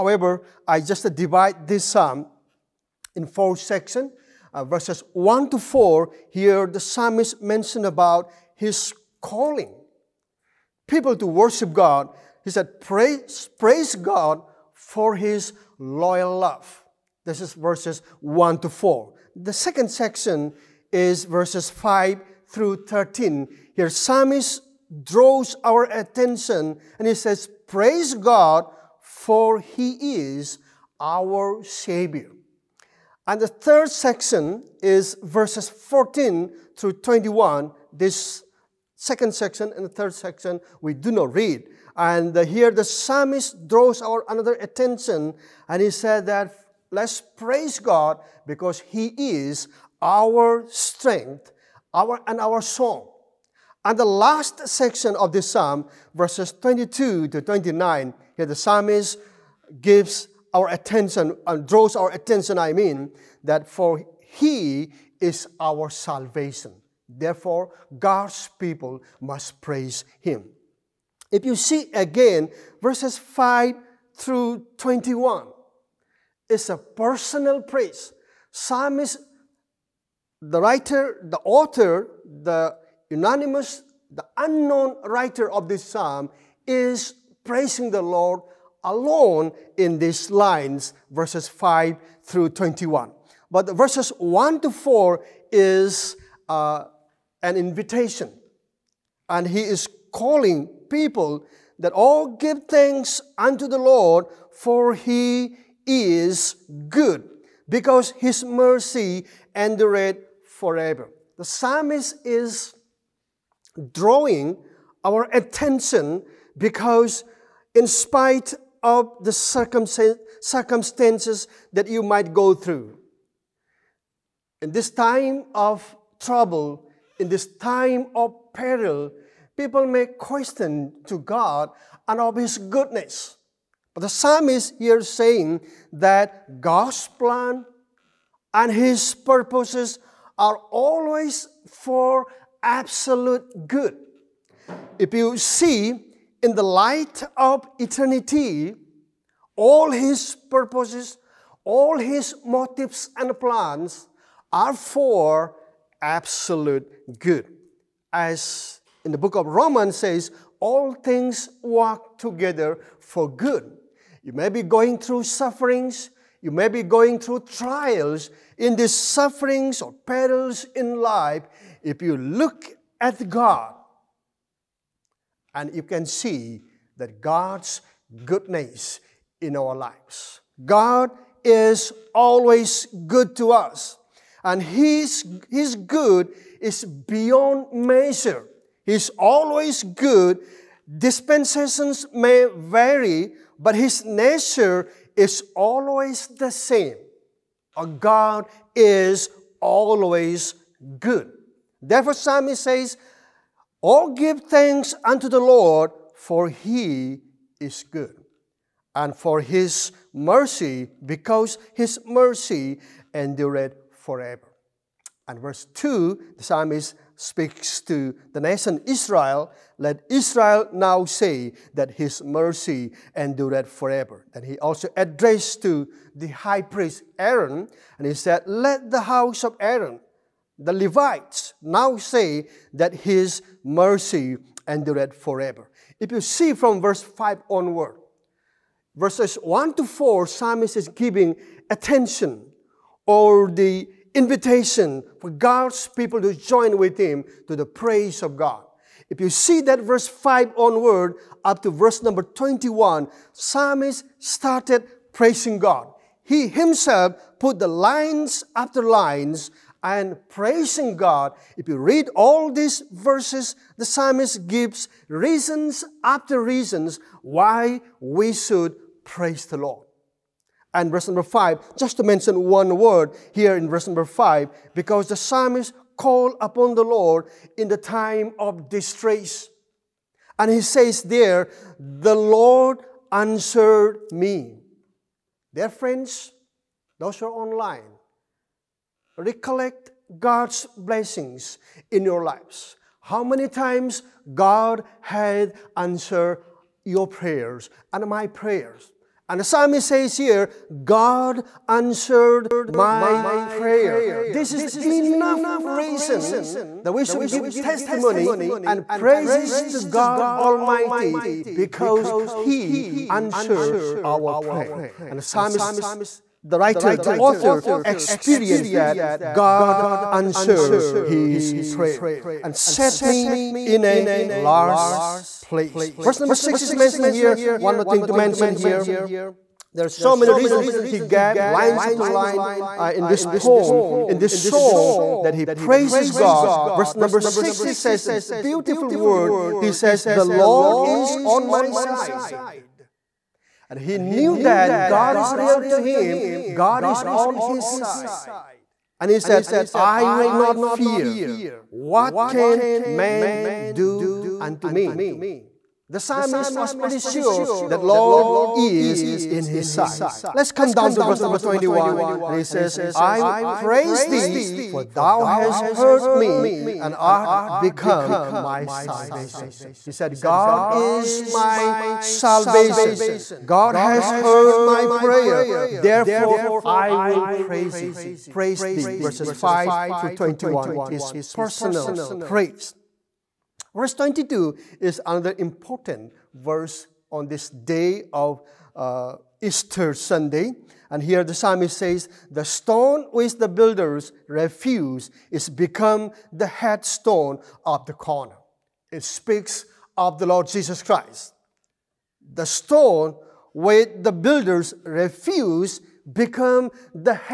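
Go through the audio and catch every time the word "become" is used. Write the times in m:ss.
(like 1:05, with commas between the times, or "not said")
6:07, 6:35, 6:46.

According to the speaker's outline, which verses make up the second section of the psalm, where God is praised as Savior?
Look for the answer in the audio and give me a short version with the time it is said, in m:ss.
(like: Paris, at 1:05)
5 through 13, at 0:21.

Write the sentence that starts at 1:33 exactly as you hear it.
But verses 1 to 4 is uh, an invitation.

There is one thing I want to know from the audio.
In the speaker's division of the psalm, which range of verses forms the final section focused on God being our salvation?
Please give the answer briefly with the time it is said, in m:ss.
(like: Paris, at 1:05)
22 to 29, at 0:56.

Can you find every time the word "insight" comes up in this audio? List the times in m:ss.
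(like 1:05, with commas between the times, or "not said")
not said.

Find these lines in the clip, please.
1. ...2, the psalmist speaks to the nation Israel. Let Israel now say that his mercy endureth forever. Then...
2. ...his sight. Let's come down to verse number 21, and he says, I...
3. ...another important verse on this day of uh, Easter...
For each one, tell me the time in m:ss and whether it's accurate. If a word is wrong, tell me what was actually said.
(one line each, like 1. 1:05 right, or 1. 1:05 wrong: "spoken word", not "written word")
1. 3:35 right
2. 5:59 right
3. 6:25 right.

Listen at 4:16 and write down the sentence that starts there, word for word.
He himself put the lines after lines and praising God.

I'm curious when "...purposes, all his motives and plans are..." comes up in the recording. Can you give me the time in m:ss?
2:30.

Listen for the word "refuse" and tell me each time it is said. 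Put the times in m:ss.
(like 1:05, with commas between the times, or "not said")
6:34, 6:44.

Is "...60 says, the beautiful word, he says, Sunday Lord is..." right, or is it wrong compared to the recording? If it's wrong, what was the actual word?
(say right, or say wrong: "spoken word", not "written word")
wrong: "The", not "Sunday".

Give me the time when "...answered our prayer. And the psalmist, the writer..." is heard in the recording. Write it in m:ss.
5:13.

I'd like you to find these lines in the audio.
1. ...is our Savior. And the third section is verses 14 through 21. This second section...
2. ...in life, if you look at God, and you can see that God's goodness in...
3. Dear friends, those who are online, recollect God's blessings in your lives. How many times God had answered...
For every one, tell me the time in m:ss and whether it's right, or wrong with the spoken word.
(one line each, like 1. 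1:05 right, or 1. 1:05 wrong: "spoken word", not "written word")
1. 0:30 right
2. 2:50 right
3. 4:45 right.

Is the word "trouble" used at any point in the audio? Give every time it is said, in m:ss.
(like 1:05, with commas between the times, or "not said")
2:06.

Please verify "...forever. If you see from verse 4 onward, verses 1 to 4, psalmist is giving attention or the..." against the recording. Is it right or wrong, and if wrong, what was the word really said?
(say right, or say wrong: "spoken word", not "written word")
wrong: "5", not "4".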